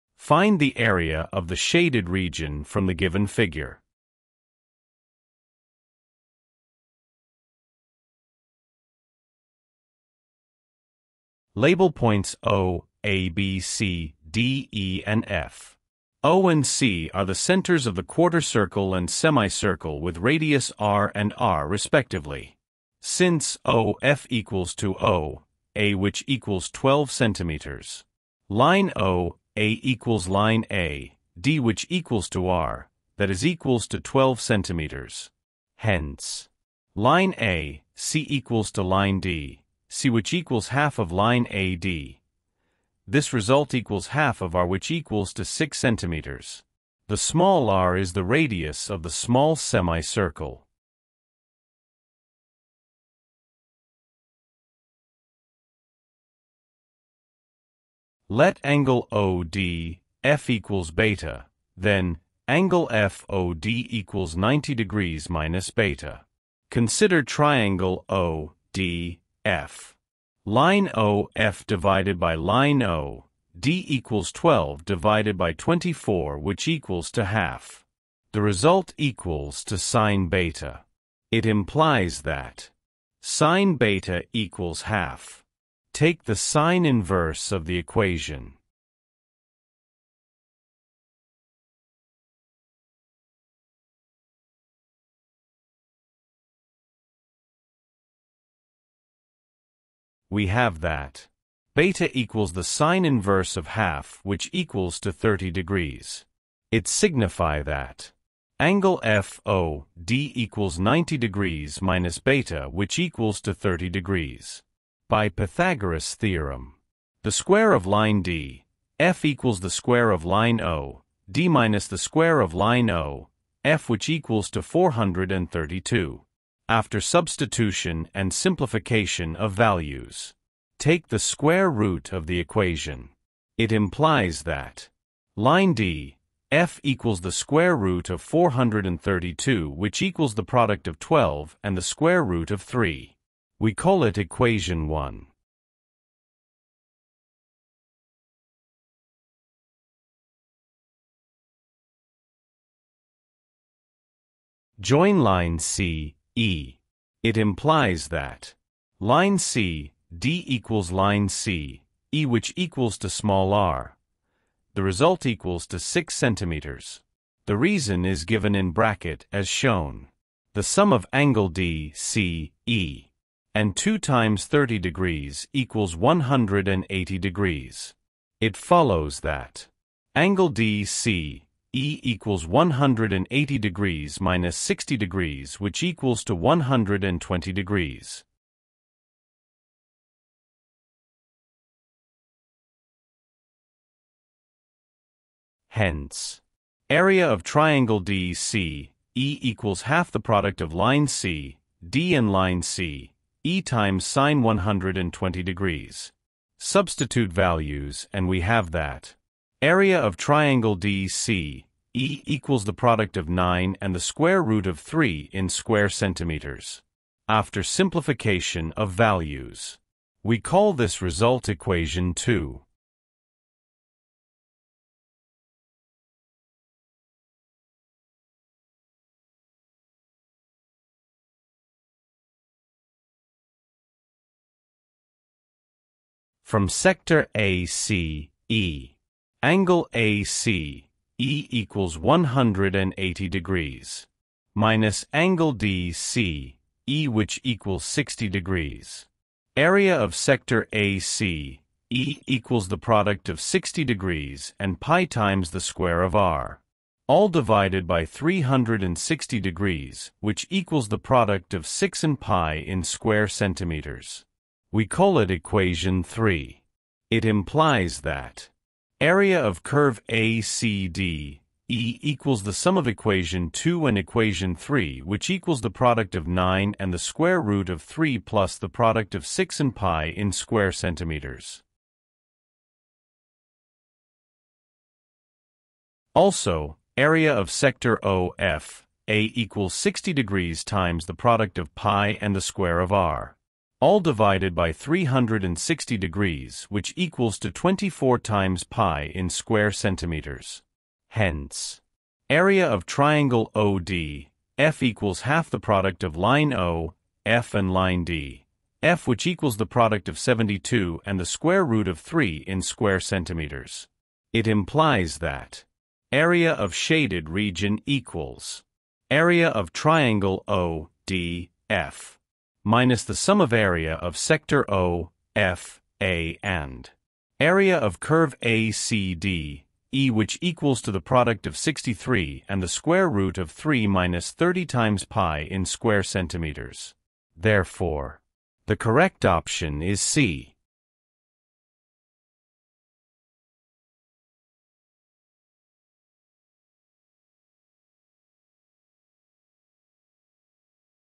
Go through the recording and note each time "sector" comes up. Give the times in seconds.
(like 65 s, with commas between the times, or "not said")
236 s, 250 s, 287 s, 324 s.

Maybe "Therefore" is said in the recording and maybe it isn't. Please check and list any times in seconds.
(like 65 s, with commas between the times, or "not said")
337 s.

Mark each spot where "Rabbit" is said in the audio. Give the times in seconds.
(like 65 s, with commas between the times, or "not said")
not said.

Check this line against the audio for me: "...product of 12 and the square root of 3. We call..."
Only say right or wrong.
right.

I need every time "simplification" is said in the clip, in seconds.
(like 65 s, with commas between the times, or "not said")
128 s, 217 s.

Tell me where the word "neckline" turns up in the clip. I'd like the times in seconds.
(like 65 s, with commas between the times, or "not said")
not said.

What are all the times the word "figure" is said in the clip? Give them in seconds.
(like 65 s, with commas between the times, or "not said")
3 s.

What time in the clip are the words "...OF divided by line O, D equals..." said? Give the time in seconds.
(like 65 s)
70 s.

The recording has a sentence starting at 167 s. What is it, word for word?
The reason is given in bracket as shown.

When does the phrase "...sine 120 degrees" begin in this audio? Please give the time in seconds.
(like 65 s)
204 s.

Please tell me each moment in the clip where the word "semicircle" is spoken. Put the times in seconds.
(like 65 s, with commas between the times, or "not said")
19 s, 49 s.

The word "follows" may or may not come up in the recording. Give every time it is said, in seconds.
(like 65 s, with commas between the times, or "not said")
178 s.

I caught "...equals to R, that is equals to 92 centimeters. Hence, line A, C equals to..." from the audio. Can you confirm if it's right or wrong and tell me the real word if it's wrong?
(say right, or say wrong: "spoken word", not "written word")
wrong: "12", not "92".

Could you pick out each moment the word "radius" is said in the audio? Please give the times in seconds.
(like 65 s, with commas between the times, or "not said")
20 s, 48 s.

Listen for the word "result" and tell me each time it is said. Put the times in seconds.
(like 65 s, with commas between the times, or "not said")
43 s, 78 s, 164 s, 221 s.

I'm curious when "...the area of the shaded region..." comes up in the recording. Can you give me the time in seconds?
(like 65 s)
0 s.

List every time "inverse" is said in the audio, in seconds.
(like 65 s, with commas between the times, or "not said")
86 s, 103 s.